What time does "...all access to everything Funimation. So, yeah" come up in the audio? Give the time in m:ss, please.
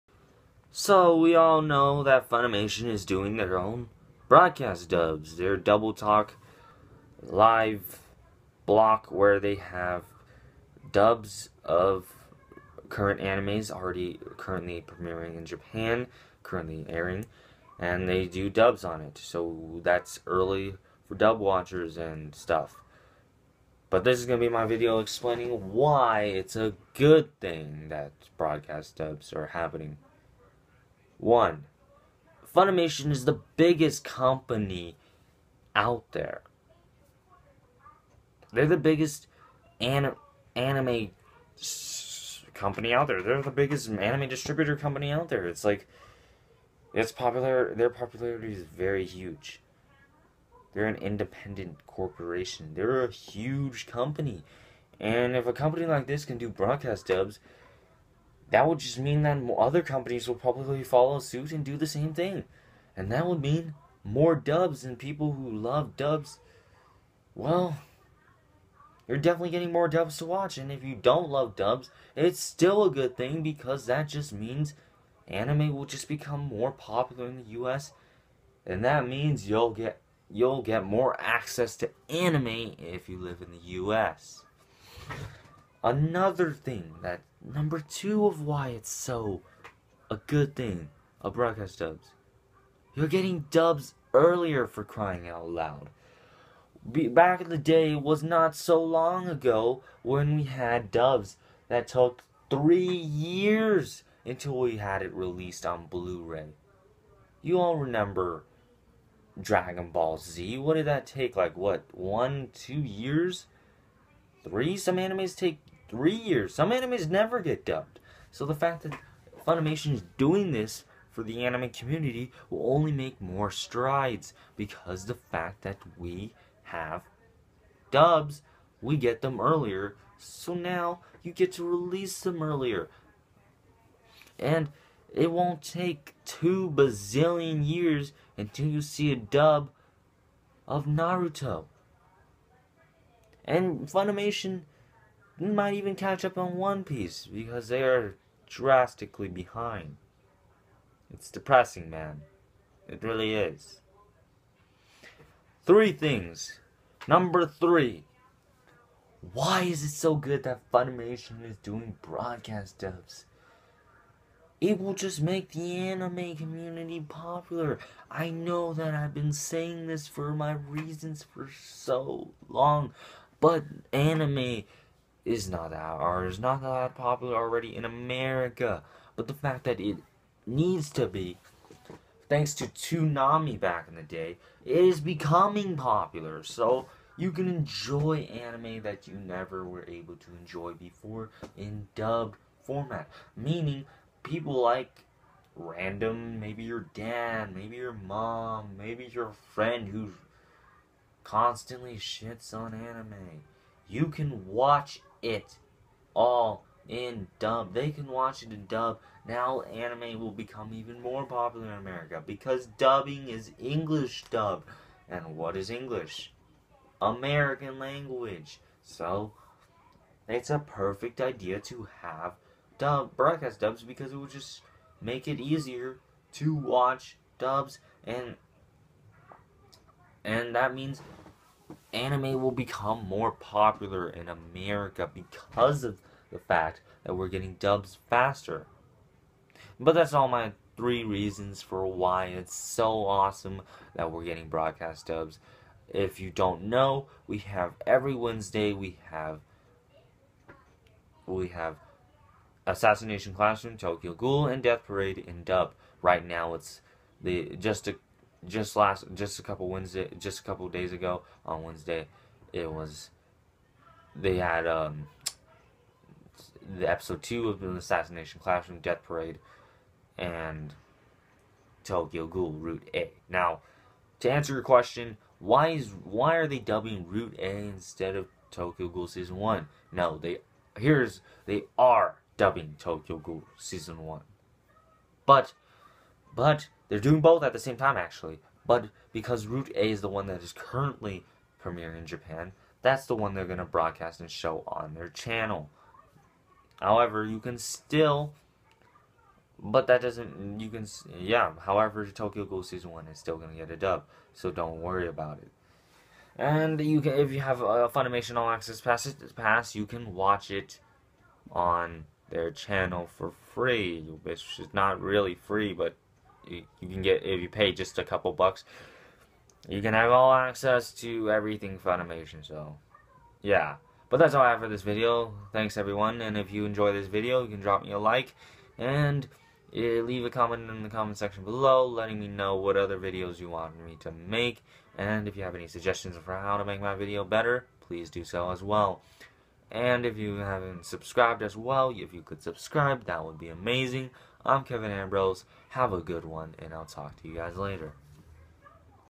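5:20.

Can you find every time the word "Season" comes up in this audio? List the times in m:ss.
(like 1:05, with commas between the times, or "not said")
4:39, 4:43, 5:02.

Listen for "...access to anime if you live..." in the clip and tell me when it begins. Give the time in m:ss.
1:21.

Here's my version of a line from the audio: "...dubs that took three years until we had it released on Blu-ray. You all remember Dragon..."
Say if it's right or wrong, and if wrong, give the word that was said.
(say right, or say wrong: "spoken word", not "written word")
right.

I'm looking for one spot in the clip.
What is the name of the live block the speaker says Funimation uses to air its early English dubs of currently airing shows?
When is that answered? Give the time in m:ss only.
0:05.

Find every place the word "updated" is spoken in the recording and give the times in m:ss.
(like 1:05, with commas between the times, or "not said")
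not said.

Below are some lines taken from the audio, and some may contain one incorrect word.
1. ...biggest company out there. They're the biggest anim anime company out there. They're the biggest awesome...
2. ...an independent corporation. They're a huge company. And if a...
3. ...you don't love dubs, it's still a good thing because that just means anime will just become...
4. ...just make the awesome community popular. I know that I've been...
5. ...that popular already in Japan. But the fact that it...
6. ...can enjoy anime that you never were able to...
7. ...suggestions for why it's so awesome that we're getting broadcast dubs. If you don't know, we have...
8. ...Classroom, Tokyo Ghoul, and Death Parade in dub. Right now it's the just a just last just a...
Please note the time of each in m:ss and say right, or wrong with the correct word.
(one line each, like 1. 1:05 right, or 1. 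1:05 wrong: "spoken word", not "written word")
1. 0:33 wrong: "anime", not "awesome"
2. 0:50 right
3. 1:10 right
4. 2:44 wrong: "anime", not "awesome"
5. 2:56 wrong: "America", not "Japan"
6. 3:07 right
7. 4:01 wrong: "reasons", not "suggestions"
8. 4:13 right.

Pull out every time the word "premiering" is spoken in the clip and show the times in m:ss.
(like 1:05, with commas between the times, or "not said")
0:14, 4:51.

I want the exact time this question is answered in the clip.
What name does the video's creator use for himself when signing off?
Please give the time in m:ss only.
5:44.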